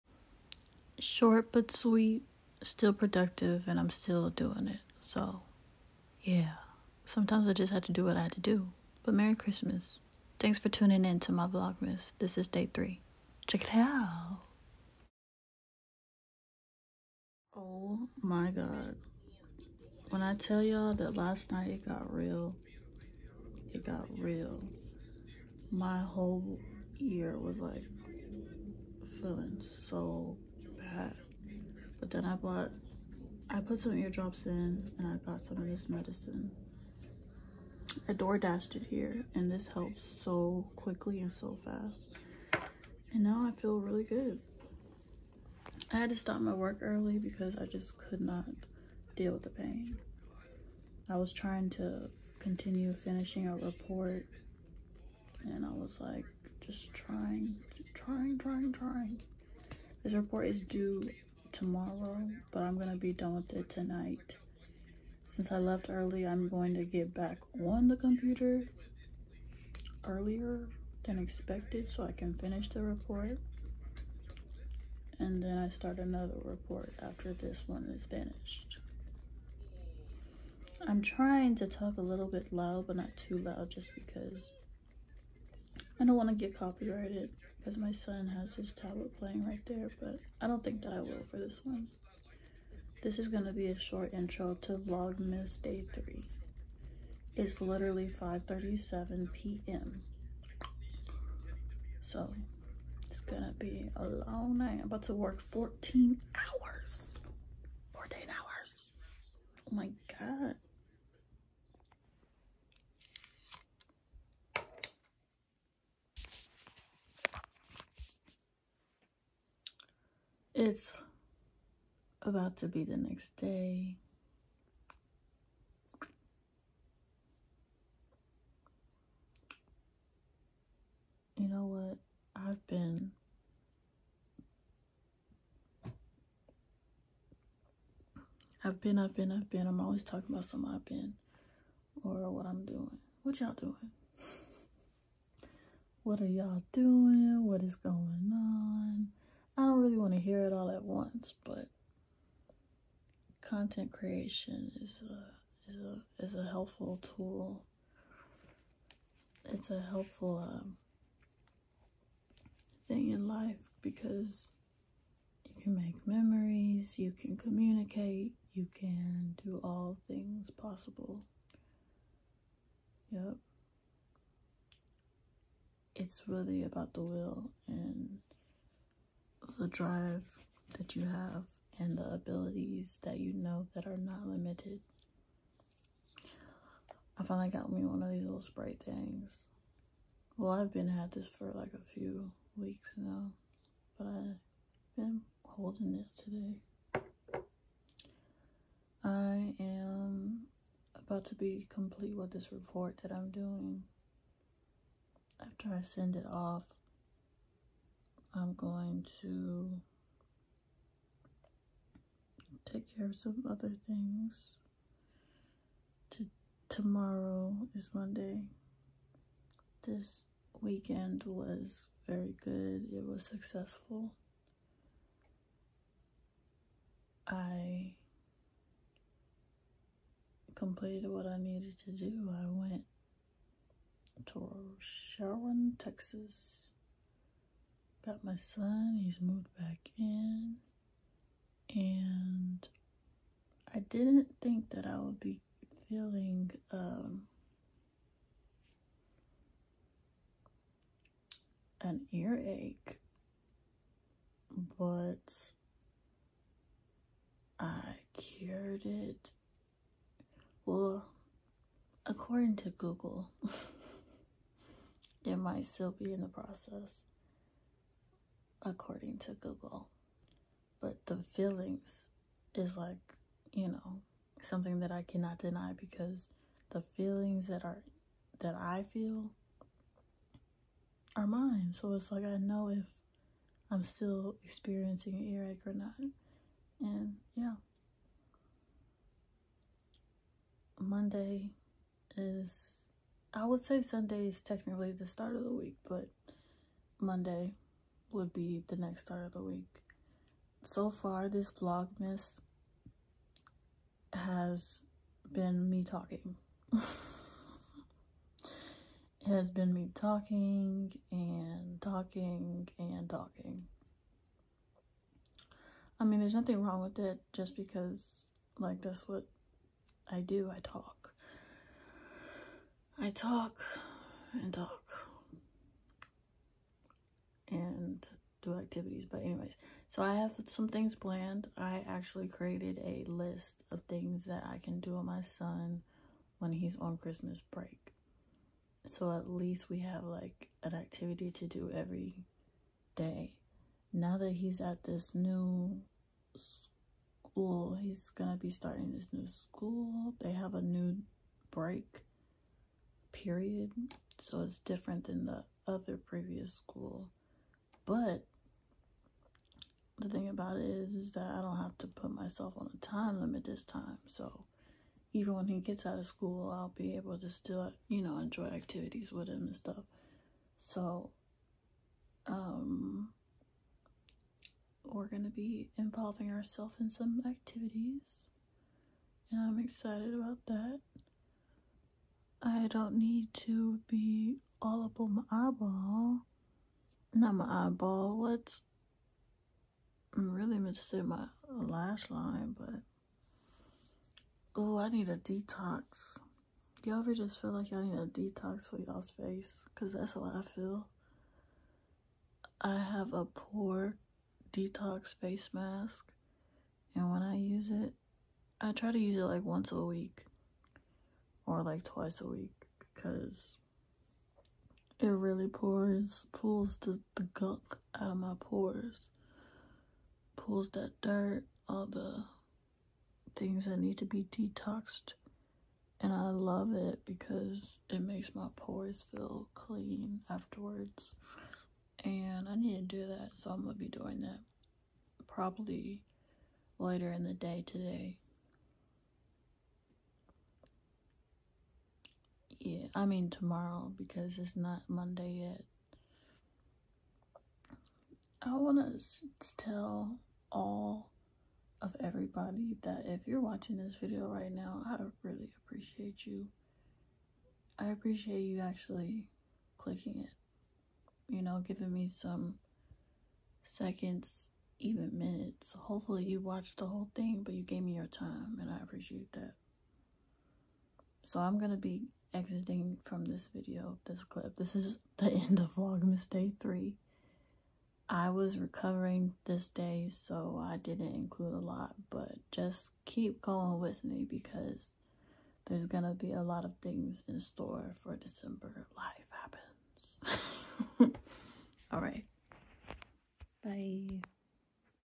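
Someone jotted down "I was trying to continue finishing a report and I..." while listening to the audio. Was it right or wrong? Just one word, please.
right.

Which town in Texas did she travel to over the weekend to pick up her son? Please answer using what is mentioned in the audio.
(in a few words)
Sharon.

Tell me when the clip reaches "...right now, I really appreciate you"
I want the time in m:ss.
7:34.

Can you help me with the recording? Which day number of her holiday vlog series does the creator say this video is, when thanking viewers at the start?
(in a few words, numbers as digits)
3.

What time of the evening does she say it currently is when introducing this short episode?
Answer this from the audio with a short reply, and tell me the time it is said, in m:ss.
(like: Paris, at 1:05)
5:37 p.m., at 1:38.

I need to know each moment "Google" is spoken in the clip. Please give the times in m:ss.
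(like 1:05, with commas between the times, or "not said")
4:22, 4:29.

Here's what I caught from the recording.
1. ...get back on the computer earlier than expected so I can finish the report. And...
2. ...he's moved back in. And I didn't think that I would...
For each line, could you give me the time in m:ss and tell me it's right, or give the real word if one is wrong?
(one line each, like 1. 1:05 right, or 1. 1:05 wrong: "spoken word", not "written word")
1. 1:06 right
2. 3:59 right.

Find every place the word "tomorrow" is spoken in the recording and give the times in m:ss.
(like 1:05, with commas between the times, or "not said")
1:01, 3:36, 7:23.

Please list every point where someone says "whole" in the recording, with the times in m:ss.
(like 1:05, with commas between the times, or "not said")
0:25, 7:46.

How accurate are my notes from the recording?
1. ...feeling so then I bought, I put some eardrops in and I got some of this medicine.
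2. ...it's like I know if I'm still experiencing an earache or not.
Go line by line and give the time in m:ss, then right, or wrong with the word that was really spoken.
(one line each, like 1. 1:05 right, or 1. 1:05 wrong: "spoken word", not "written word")
1. 0:29 right
2. 4:41 right.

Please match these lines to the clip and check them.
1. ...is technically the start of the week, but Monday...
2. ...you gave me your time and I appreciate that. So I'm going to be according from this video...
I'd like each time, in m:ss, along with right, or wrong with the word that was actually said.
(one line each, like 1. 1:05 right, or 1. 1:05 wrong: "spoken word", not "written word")
1. 4:54 right
2. 7:47 wrong: "exiting", not "according".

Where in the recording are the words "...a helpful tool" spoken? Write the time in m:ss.
2:36.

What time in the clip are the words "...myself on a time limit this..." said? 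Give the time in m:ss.
6:02.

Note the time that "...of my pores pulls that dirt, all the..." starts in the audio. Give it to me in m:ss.
6:58.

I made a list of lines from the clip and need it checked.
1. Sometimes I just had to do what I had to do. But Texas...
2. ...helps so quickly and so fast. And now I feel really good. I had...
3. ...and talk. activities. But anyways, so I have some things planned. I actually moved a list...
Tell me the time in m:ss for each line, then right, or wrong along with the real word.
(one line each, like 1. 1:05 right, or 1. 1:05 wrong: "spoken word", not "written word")
1. 0:07 wrong: "Merry", not "Texas"
2. 0:39 right
3. 5:24 wrong: "created", not "moved".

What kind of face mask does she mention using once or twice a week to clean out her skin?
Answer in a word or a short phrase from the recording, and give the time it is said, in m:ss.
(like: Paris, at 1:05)
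pore detox face mask, at 6:43.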